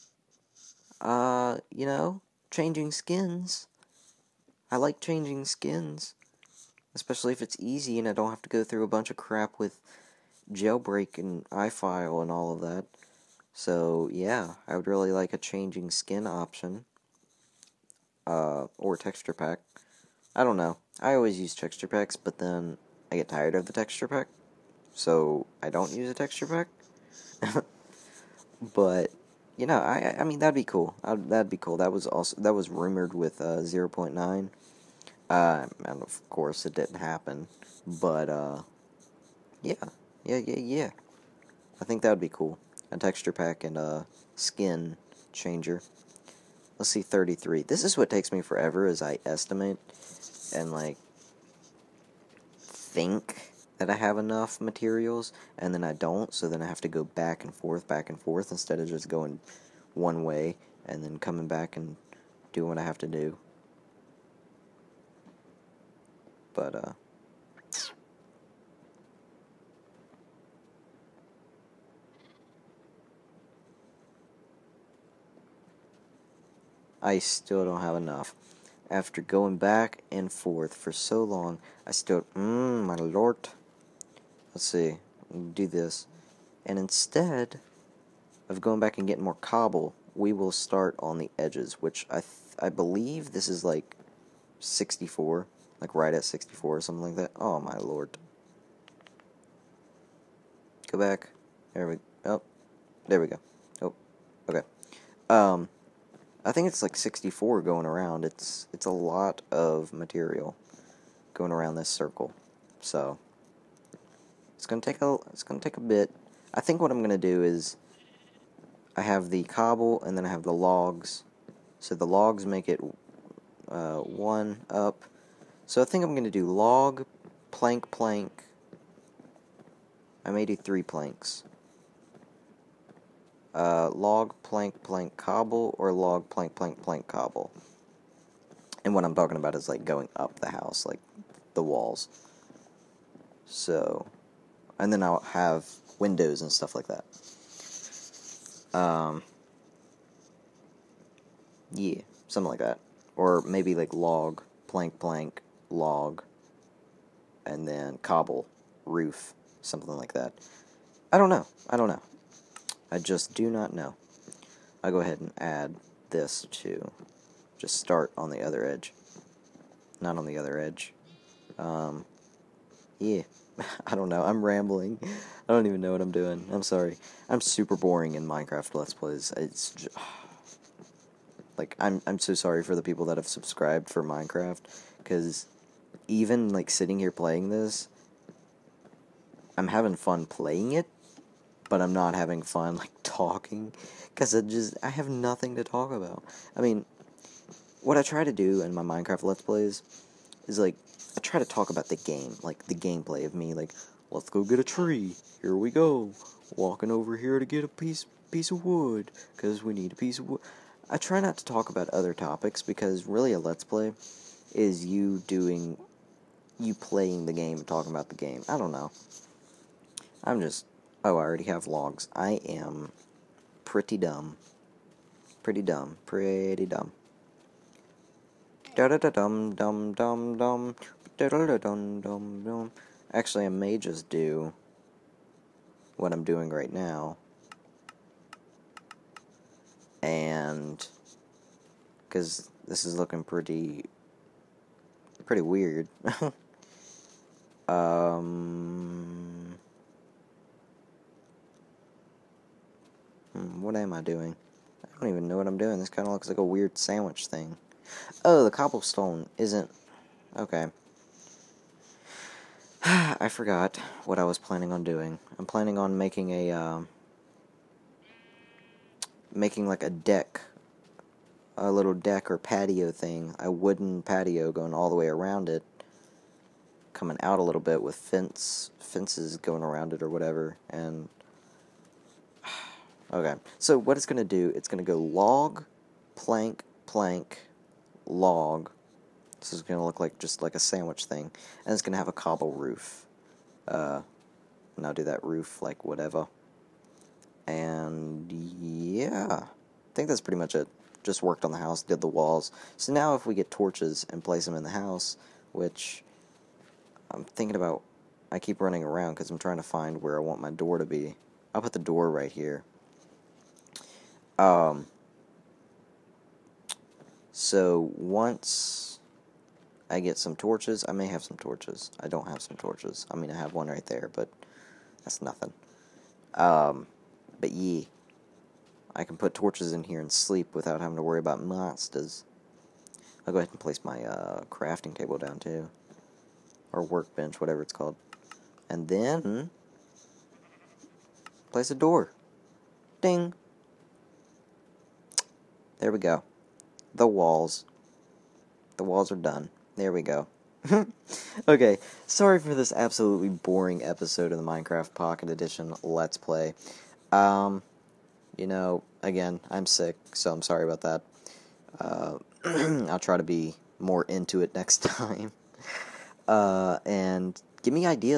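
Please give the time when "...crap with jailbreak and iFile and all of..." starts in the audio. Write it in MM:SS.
00:09.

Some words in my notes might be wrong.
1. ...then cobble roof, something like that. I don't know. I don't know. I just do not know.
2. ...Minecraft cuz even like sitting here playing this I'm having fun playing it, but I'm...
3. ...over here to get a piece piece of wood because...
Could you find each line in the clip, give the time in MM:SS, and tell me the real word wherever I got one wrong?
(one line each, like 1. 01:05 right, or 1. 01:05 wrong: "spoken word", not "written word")
1. 02:37 right
2. 03:04 right
3. 03:26 right.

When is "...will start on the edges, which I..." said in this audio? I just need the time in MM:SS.
01:30.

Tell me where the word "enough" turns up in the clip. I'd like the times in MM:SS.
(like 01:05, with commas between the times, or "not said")
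00:54, 01:17.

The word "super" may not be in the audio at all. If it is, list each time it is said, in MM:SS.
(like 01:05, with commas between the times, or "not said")
02:57.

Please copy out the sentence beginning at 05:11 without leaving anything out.
I'll put the door right here.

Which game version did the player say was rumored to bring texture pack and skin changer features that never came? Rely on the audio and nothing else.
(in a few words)
0.9.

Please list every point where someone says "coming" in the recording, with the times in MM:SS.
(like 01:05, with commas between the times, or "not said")
01:01, 04:36.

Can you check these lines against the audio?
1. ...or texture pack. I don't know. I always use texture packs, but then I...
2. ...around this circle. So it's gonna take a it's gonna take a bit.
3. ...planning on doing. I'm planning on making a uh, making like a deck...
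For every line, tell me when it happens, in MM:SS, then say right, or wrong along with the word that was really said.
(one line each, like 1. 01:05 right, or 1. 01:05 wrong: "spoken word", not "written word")
1. 00:18 right
2. 01:51 right
3. 04:24 right.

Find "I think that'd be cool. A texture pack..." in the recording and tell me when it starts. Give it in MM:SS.
00:41.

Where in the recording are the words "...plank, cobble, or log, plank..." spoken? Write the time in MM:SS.
02:14.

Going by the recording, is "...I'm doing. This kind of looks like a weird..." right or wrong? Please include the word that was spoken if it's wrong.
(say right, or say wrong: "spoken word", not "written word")
right.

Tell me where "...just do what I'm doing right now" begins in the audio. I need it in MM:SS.
03:53.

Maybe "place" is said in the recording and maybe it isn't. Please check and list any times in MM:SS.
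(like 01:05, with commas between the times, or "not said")
05:04, 05:33, 05:41.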